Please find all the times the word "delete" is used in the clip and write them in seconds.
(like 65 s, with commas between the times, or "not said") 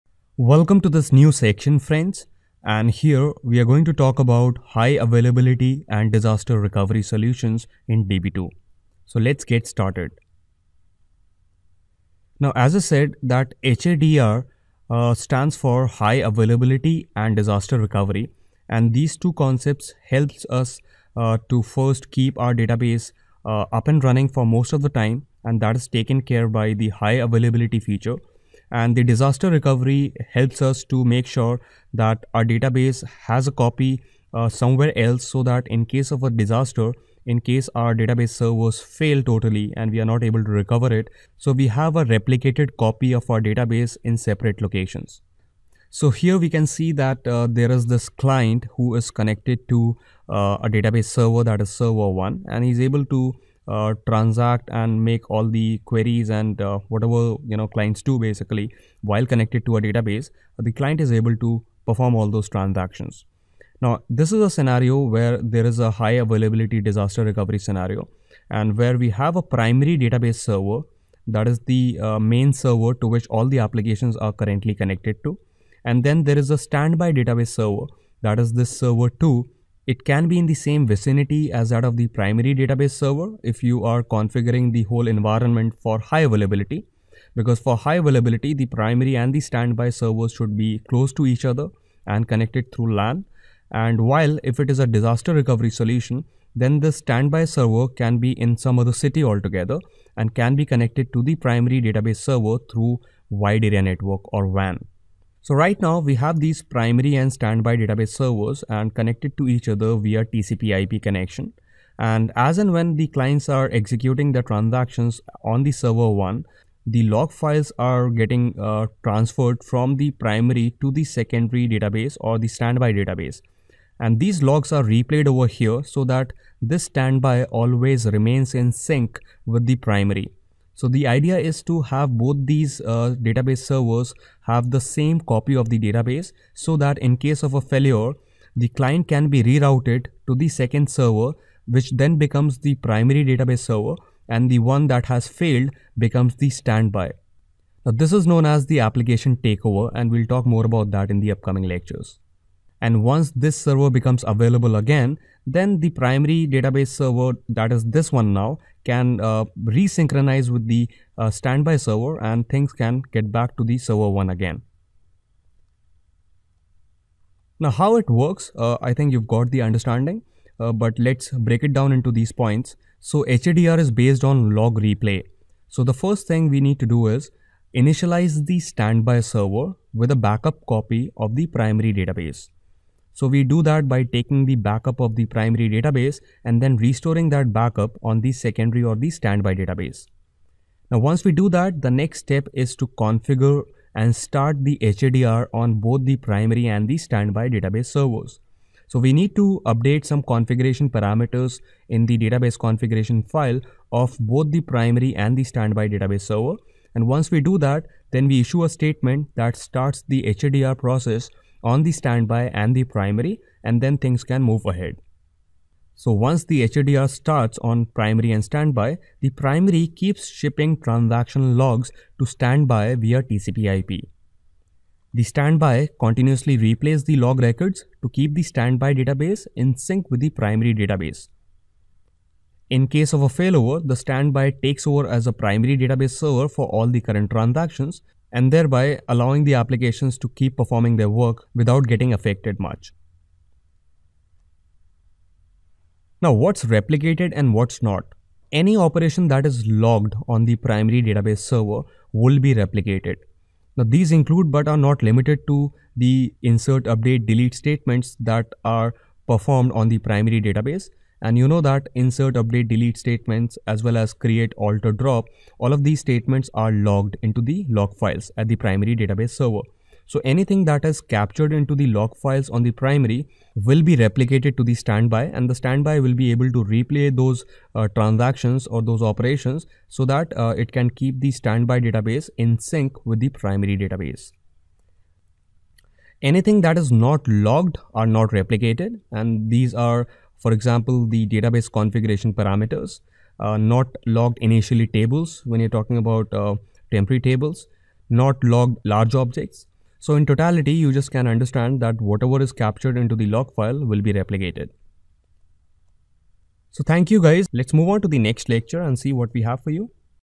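257 s, 262 s.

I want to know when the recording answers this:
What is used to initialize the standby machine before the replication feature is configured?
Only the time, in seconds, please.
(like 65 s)
180 s.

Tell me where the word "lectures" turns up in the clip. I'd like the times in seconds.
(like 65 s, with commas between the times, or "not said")
151 s, 308 s.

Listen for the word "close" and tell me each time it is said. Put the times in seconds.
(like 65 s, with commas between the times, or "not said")
90 s.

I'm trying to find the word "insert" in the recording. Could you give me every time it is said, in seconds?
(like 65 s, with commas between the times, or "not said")
256 s, 261 s.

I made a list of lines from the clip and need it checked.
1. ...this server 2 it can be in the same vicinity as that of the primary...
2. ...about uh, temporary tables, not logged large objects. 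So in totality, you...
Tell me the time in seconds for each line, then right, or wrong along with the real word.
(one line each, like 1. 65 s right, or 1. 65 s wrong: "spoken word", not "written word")
1. 78 s right
2. 295 s right.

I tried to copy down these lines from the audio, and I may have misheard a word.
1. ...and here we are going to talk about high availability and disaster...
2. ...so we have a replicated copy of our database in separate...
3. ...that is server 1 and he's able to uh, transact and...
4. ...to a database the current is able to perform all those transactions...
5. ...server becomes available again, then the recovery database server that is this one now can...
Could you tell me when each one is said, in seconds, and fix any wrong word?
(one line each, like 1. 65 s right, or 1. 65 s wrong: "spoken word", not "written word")
1. 2 s right
2. 41 s right
3. 51 s right
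4. 59 s wrong: "client", not "current"
5. 153 s wrong: "primary", not "recovery".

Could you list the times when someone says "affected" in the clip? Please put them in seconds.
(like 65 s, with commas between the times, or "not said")
242 s.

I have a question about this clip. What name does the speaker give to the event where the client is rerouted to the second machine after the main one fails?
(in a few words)
Application takeover.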